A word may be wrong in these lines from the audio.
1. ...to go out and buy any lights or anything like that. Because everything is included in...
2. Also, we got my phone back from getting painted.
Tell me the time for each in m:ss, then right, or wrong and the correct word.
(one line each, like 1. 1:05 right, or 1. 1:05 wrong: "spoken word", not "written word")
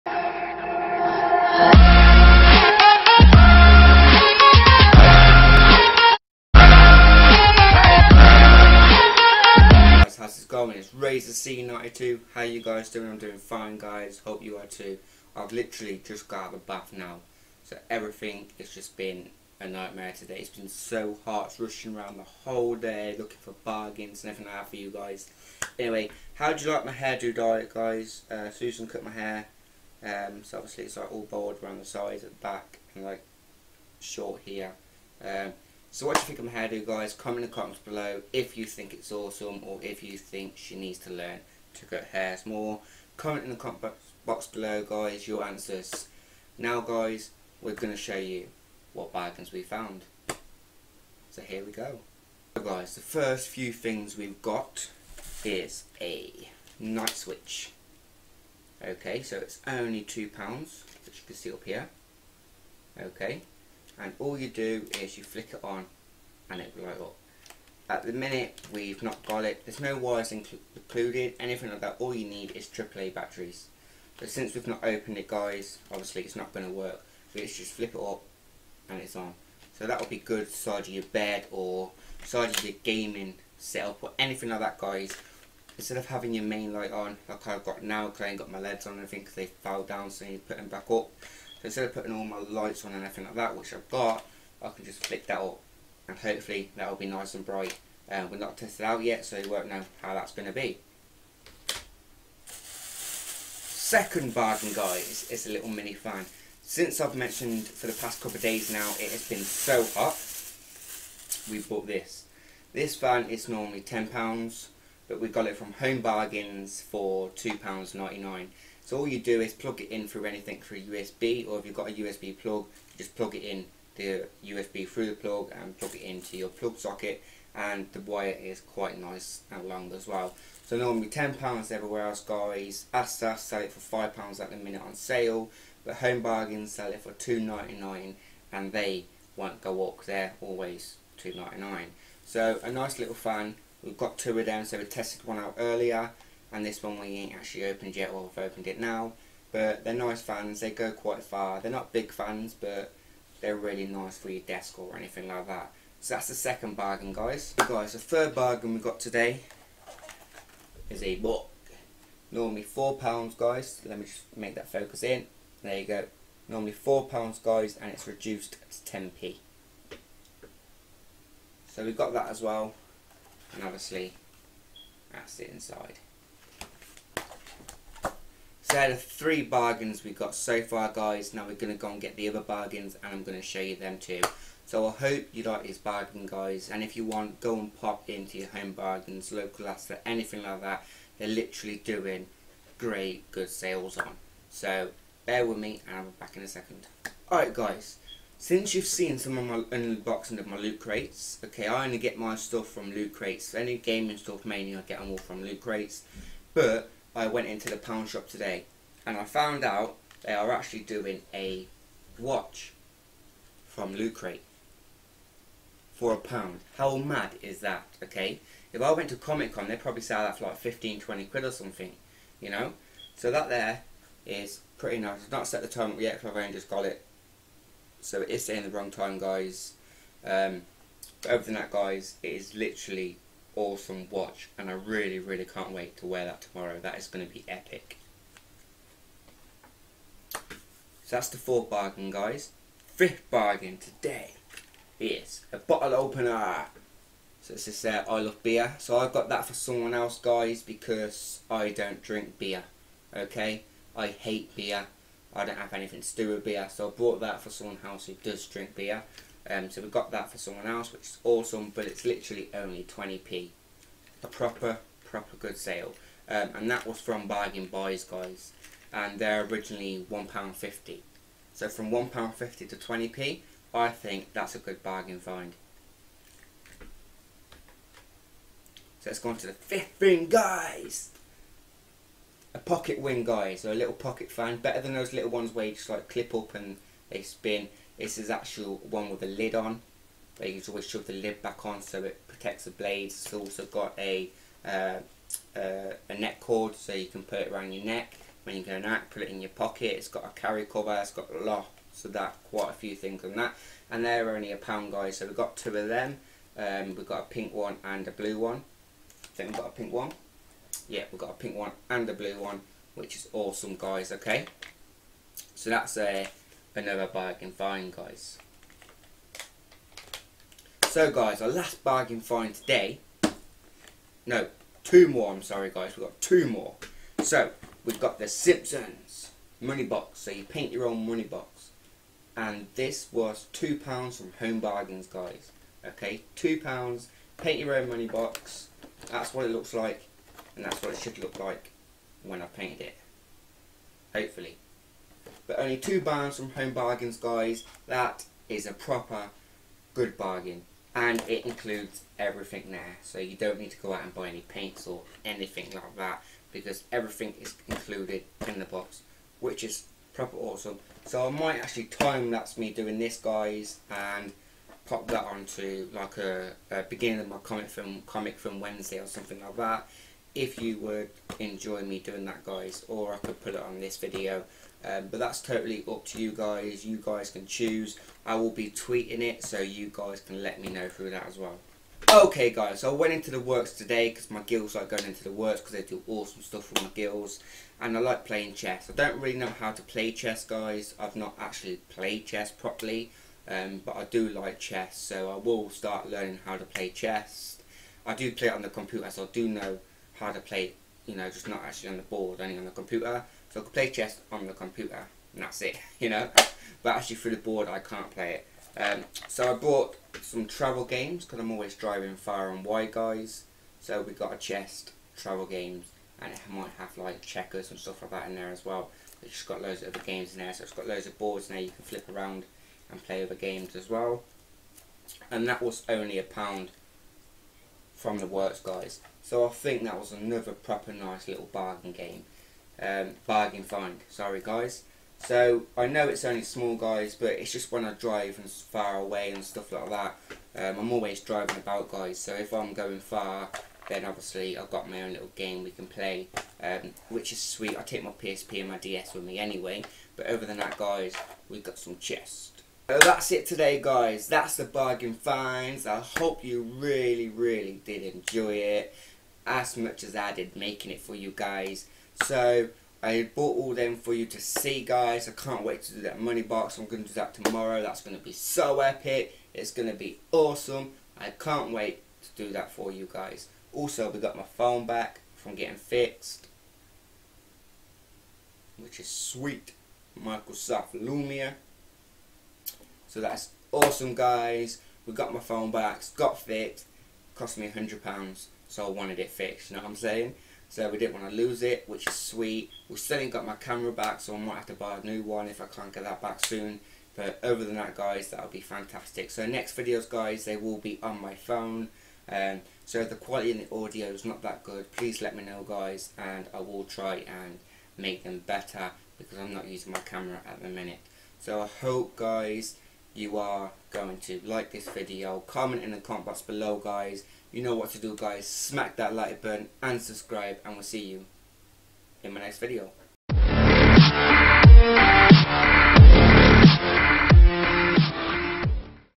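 1. 5:53 wrong: "paints", not "lights"
2. 7:53 wrong: "fixed", not "painted".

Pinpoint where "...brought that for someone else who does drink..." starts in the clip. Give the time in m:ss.
4:16.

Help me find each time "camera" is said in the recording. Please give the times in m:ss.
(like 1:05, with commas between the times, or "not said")
8:13, 8:29.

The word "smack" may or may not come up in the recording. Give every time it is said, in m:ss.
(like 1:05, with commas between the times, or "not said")
8:38.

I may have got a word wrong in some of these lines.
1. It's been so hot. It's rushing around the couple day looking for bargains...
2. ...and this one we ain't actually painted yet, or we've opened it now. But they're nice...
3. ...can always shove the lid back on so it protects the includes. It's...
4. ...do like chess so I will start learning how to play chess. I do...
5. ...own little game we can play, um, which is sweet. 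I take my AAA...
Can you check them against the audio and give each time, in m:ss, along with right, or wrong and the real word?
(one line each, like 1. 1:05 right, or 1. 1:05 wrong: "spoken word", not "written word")
1. 0:20 wrong: "whole", not "couple"
2. 2:26 wrong: "opened", not "painted"
3. 4:50 wrong: "blades", not "includes"
4. 6:34 right
5. 7:25 wrong: "PSP", not "AAA".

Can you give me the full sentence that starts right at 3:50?
Um, but other than that, guys, it is literally awesome watch and I really really can't wait to wear that tomorrow.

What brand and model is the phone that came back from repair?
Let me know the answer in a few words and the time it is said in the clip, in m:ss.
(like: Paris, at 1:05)
Microsoft Lumia, at 8:00.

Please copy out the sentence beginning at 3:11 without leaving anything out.
They're literally doing great good sales on.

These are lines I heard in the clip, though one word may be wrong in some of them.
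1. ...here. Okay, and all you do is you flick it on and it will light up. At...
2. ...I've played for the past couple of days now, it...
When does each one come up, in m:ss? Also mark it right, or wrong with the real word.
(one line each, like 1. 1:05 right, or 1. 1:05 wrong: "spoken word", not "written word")
1. 1:01 right
2. 1:46 wrong: "mentioned", not "played".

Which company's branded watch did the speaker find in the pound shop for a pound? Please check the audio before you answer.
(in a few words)
Loot Crate.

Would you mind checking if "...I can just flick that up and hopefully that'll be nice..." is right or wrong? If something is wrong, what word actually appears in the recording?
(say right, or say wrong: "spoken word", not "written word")
right.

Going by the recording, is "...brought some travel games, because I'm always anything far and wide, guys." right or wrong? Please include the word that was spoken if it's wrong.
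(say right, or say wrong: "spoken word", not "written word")
wrong: "driving", not "anything".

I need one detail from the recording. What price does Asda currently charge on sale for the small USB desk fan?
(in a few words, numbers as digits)
£5.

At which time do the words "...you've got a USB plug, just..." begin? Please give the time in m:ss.
2:01.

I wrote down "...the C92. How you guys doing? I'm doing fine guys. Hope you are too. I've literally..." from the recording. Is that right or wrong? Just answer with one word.
right.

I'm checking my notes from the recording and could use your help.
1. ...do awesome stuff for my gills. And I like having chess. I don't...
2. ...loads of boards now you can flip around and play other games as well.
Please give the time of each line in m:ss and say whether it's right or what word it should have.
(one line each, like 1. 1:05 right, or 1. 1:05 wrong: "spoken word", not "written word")
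1. 6:25 wrong: "playing", not "having"
2. 7:00 right.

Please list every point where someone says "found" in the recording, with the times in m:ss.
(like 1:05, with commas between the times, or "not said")
0:49, 3:29.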